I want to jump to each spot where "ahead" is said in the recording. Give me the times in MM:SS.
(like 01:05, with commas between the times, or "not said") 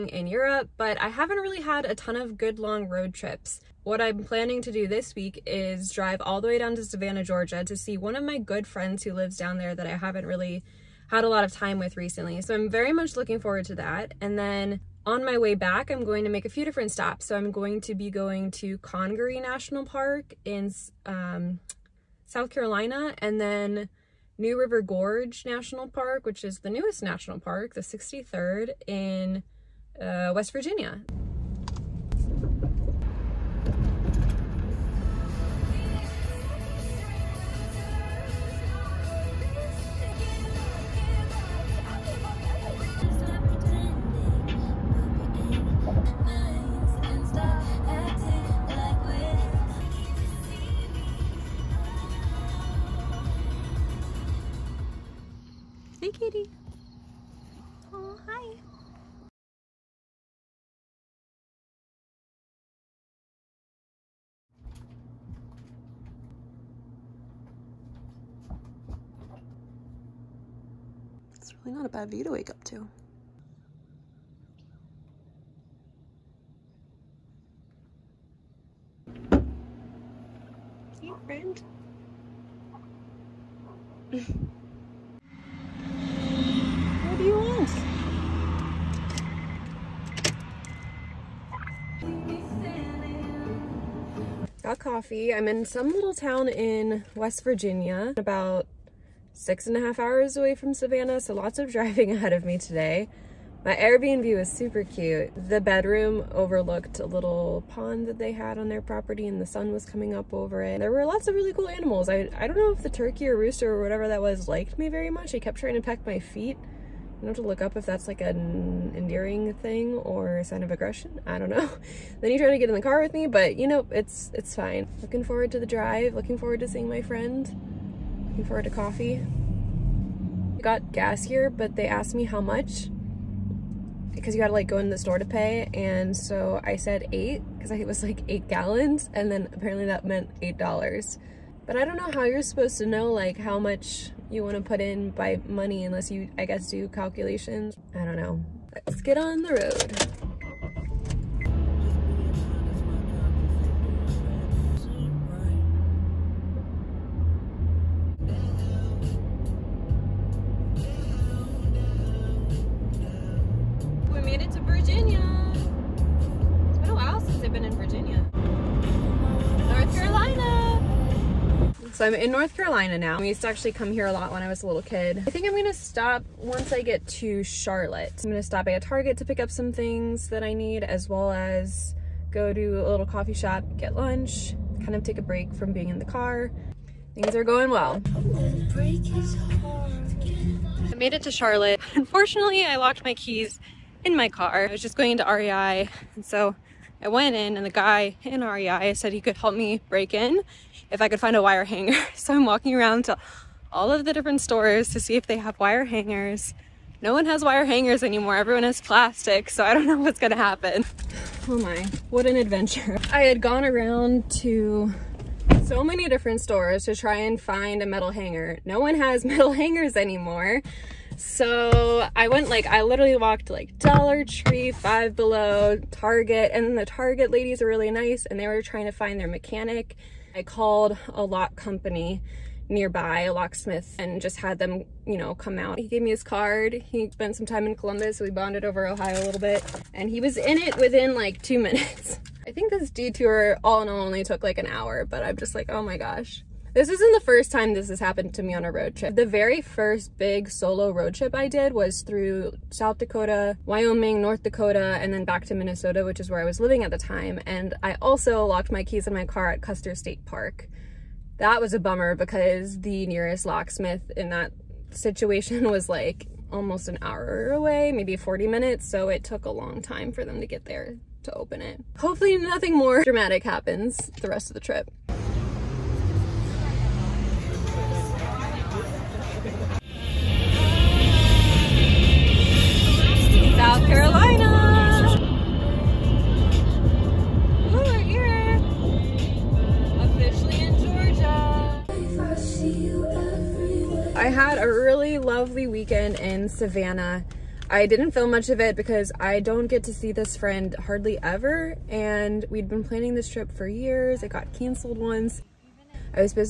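01:42.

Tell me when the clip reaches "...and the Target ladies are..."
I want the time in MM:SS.
03:46.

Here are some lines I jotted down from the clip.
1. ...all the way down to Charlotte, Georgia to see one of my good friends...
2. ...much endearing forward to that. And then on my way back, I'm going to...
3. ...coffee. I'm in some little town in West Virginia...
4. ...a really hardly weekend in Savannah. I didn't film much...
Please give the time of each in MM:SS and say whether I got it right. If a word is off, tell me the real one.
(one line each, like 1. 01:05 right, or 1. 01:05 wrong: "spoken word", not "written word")
1. 00:06 wrong: "Savannah", not "Charlotte"
2. 00:12 wrong: "looking", not "endearing"
3. 01:34 right
4. 04:54 wrong: "lovely", not "hardly".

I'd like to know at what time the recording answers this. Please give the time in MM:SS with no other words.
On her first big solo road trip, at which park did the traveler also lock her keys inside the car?
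04:19.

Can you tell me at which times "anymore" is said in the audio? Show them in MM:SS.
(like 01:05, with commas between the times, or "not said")
03:28, 03:39.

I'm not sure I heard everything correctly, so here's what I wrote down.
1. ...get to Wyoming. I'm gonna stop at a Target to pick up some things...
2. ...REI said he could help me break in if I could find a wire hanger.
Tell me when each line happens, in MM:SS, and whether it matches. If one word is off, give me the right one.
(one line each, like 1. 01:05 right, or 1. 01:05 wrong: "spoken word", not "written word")
1. 02:56 wrong: "Charlotte", not "Wyoming"
2. 03:18 right.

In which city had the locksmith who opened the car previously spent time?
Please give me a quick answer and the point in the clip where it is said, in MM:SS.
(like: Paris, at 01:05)
Columbus, at 03:57.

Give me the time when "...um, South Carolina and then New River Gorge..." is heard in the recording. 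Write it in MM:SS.
00:21.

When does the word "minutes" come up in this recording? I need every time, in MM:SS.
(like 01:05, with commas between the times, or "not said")
04:01, 04:28.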